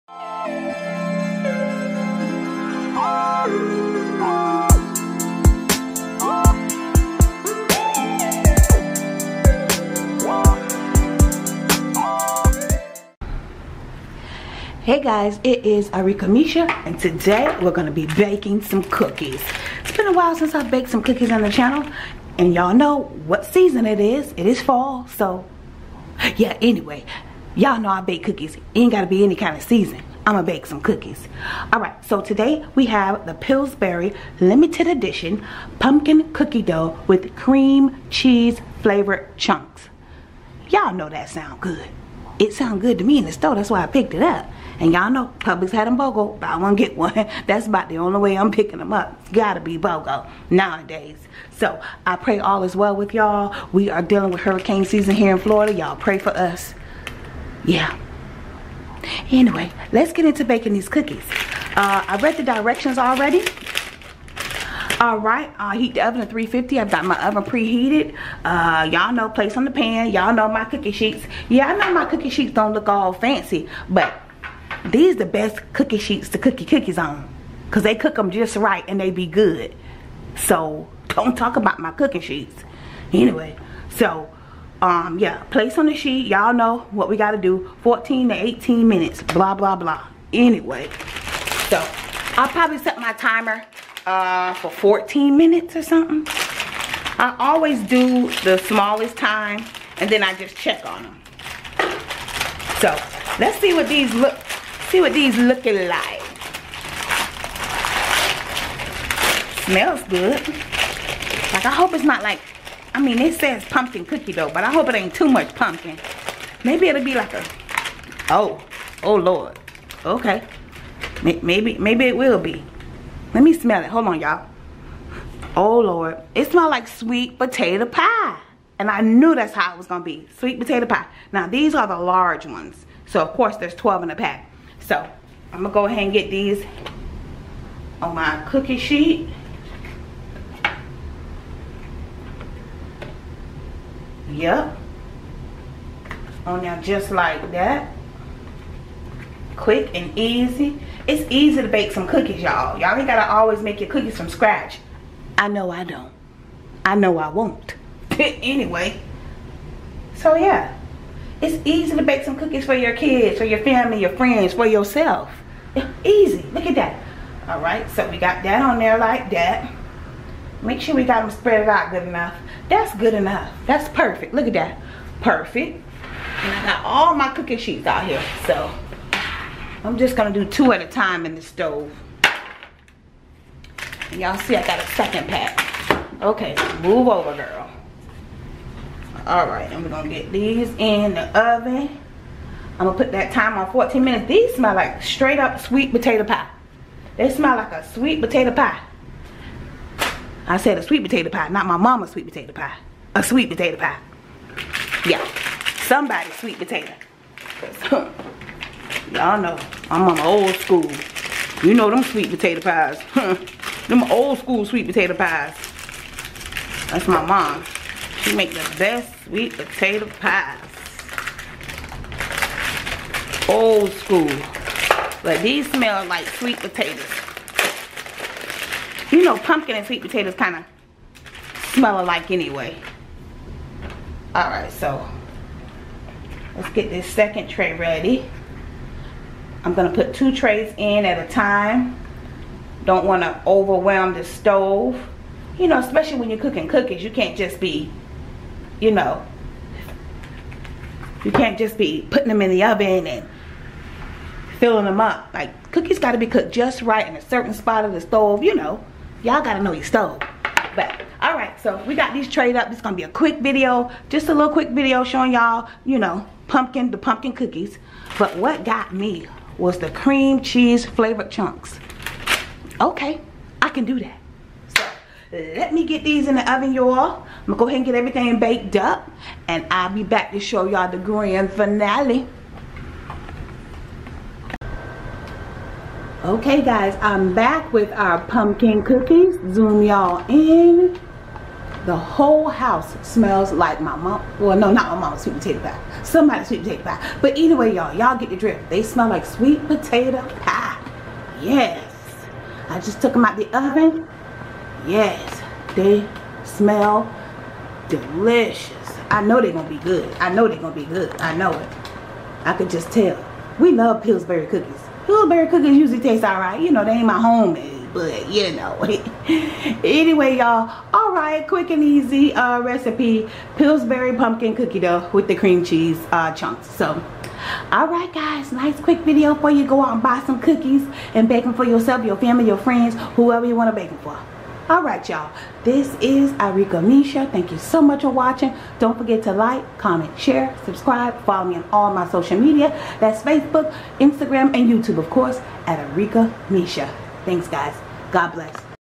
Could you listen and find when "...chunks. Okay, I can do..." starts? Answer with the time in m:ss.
4:31.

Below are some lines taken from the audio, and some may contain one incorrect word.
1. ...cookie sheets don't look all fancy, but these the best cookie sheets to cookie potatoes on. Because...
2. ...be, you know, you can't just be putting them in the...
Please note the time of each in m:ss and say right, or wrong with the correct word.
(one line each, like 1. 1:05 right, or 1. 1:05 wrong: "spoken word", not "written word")
1. 1:12 wrong: "cookies", not "potatoes"
2. 4:07 right.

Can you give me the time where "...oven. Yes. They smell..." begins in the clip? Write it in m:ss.
5:03.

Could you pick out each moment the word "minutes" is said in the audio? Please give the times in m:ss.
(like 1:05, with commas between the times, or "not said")
1:28, 1:35, 3:14.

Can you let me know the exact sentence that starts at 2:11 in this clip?
Now, these are the large ones.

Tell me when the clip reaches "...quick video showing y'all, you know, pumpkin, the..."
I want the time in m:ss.
4:24.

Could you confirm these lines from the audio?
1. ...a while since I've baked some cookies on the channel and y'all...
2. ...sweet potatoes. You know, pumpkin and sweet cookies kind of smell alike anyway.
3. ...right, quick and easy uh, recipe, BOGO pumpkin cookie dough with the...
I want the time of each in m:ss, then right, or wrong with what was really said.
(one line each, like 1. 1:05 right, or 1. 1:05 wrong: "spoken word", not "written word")
1. 0:20 right
2. 3:46 wrong: "potatoes", not "cookies"
3. 5:21 wrong: "Pillsbury", not "BOGO".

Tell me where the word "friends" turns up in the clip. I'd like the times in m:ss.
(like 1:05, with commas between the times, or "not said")
2:44, 5:32.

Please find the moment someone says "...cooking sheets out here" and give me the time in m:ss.
2:57.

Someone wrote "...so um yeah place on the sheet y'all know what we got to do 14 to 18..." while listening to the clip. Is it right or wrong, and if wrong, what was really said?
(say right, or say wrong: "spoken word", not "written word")
right.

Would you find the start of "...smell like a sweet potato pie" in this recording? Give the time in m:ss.
3:17.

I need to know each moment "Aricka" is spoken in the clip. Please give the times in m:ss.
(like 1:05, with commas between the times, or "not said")
0:15, 5:36, 5:45.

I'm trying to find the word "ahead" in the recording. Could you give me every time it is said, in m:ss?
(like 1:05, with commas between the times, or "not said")
2:15, 4:37.